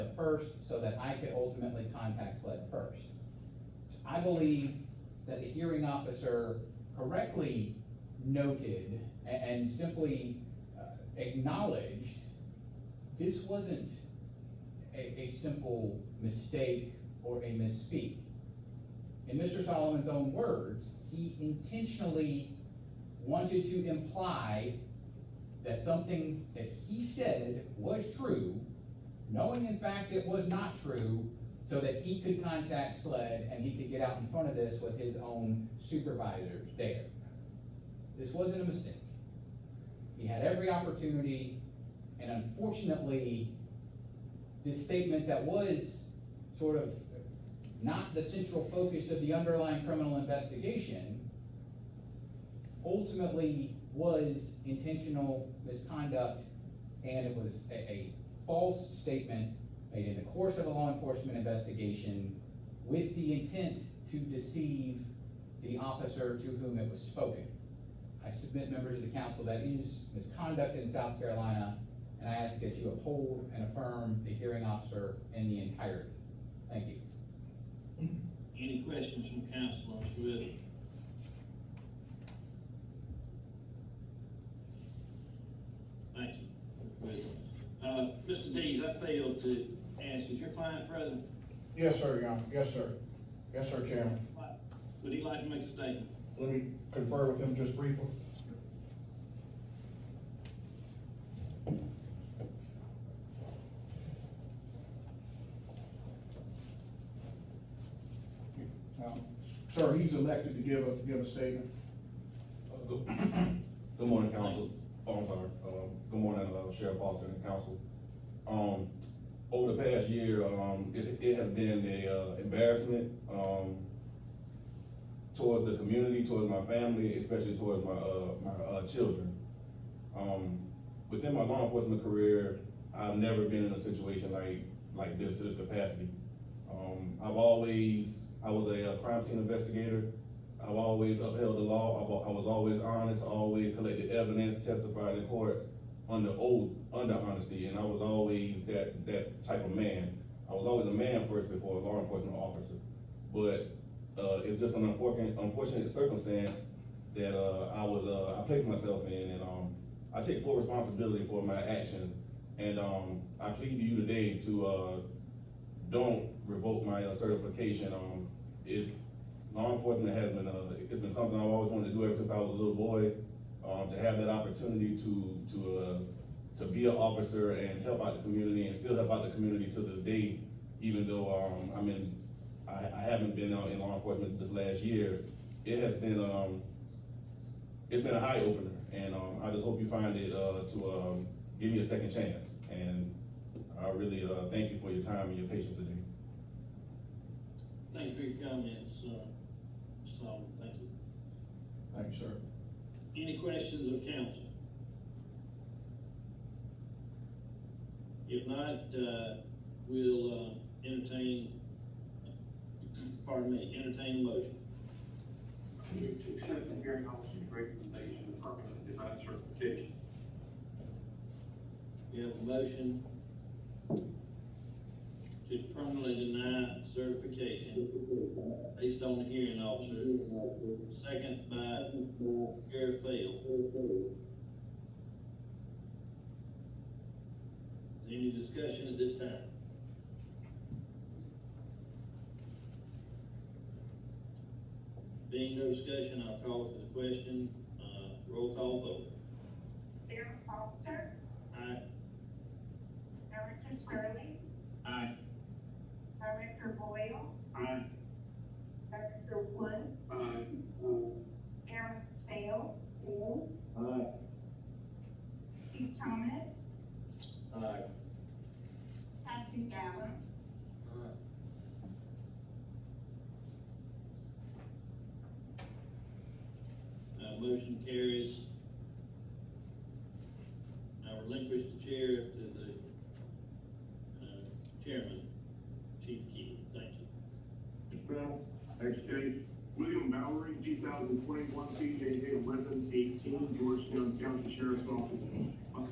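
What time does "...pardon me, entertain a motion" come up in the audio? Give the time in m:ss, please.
3:33.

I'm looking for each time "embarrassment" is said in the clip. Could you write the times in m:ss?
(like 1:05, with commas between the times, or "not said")
2:02.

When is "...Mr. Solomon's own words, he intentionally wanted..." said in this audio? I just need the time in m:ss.
0:19.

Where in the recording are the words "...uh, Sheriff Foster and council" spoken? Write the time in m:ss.
1:56.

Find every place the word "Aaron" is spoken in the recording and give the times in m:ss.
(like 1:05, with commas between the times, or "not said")
4:21.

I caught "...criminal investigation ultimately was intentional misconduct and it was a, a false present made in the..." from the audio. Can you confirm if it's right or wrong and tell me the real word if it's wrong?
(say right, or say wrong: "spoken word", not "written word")
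wrong: "statement", not "present".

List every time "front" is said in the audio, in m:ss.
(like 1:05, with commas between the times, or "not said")
0:34.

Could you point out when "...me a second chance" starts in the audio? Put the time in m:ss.
3:11.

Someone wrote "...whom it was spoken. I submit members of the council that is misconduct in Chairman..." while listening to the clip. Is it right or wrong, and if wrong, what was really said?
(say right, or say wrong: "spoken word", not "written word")
wrong: "South", not "Chairman".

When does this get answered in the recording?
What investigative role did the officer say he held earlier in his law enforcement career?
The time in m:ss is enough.
2:18.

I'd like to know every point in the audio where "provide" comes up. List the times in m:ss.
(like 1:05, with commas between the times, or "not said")
not said.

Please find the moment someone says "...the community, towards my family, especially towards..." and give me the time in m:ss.
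2:05.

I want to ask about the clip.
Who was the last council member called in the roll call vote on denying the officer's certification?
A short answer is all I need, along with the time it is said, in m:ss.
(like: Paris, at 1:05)
Patrick Allen, at 4:29.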